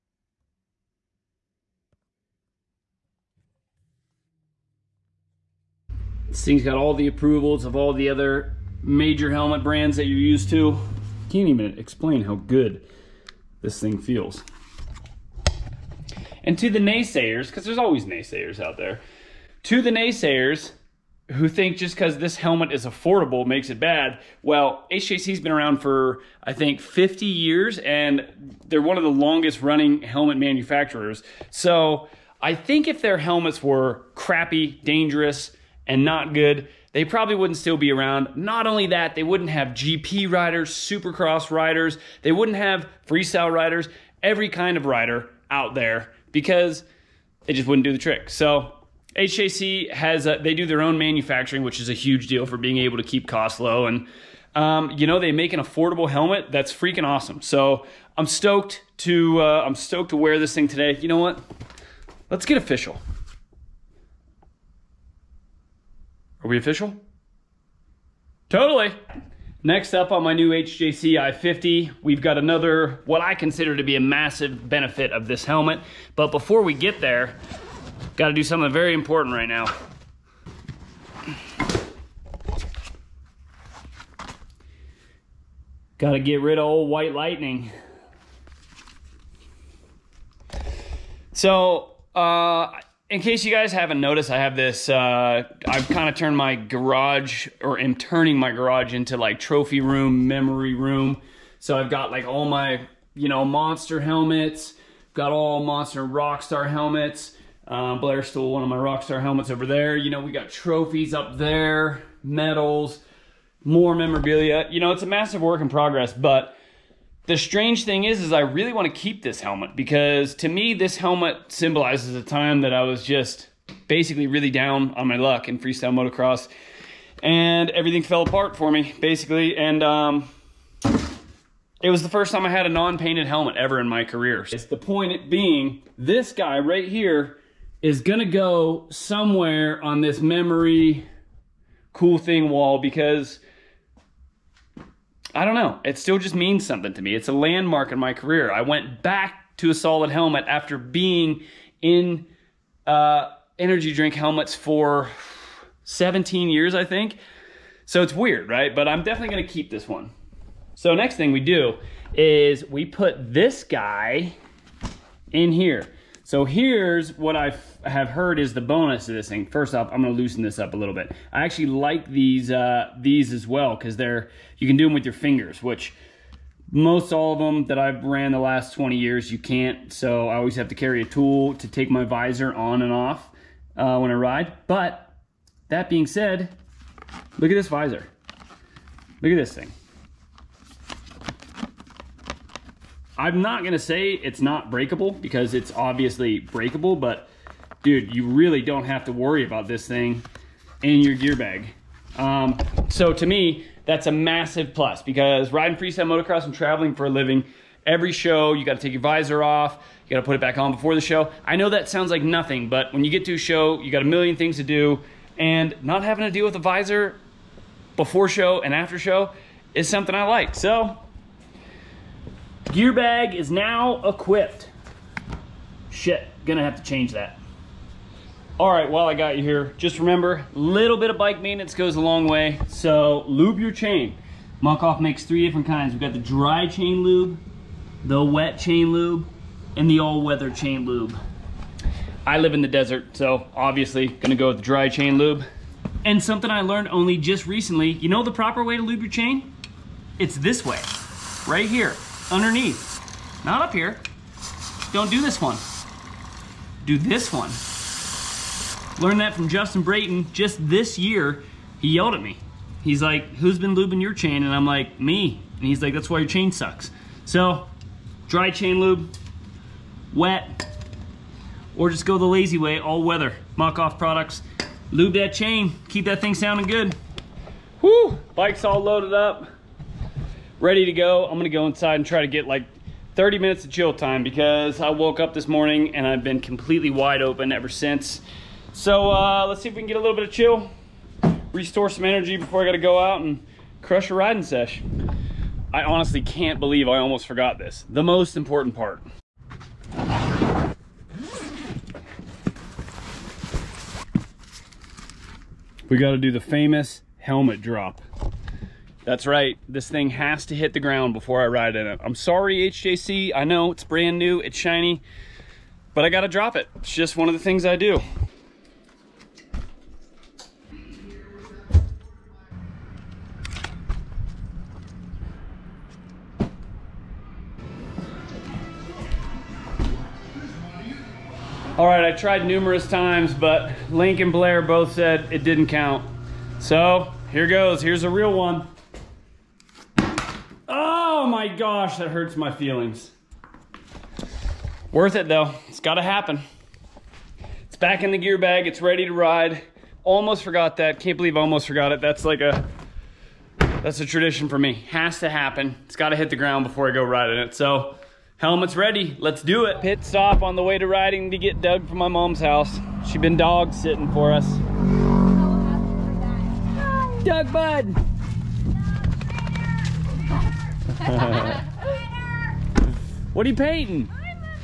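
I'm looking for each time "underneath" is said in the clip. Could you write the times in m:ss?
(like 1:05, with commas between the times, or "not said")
4:12.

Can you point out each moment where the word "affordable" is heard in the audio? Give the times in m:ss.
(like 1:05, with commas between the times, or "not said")
0:22, 0:55.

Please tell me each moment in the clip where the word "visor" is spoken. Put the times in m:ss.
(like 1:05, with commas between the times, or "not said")
3:02, 3:07, 3:29, 3:36.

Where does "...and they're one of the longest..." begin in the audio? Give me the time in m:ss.
0:27.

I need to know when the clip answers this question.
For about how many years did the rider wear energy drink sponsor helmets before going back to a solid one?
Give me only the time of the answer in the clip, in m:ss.
2:35.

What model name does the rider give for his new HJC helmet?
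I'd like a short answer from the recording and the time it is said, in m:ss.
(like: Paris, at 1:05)
i50, at 1:11.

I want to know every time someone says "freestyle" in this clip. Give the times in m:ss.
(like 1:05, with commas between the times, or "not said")
0:43, 2:05, 3:25.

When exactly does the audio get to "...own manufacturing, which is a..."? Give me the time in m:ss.
0:50.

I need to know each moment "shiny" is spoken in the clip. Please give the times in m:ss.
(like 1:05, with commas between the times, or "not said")
5:14.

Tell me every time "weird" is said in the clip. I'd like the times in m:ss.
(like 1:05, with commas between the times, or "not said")
2:38.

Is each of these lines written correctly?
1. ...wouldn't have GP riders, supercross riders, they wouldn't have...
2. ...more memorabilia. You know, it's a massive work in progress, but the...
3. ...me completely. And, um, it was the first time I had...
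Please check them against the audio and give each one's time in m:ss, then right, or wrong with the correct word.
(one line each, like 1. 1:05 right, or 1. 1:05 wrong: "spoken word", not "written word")
1. 0:39 right
2. 1:53 right
3. 2:08 wrong: "basically", not "completely".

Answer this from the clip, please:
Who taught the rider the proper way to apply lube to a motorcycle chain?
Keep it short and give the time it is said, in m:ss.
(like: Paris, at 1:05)
Justin Brayton, at 4:19.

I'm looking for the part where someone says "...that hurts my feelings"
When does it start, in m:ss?
5:41.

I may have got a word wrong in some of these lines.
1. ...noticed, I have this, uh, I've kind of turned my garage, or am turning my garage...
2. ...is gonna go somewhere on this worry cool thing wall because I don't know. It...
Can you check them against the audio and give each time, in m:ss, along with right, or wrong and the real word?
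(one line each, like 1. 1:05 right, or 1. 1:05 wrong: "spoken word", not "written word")
1. 1:33 right
2. 2:17 wrong: "memory", not "worry".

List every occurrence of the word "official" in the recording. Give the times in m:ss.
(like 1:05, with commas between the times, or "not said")
1:02, 1:06.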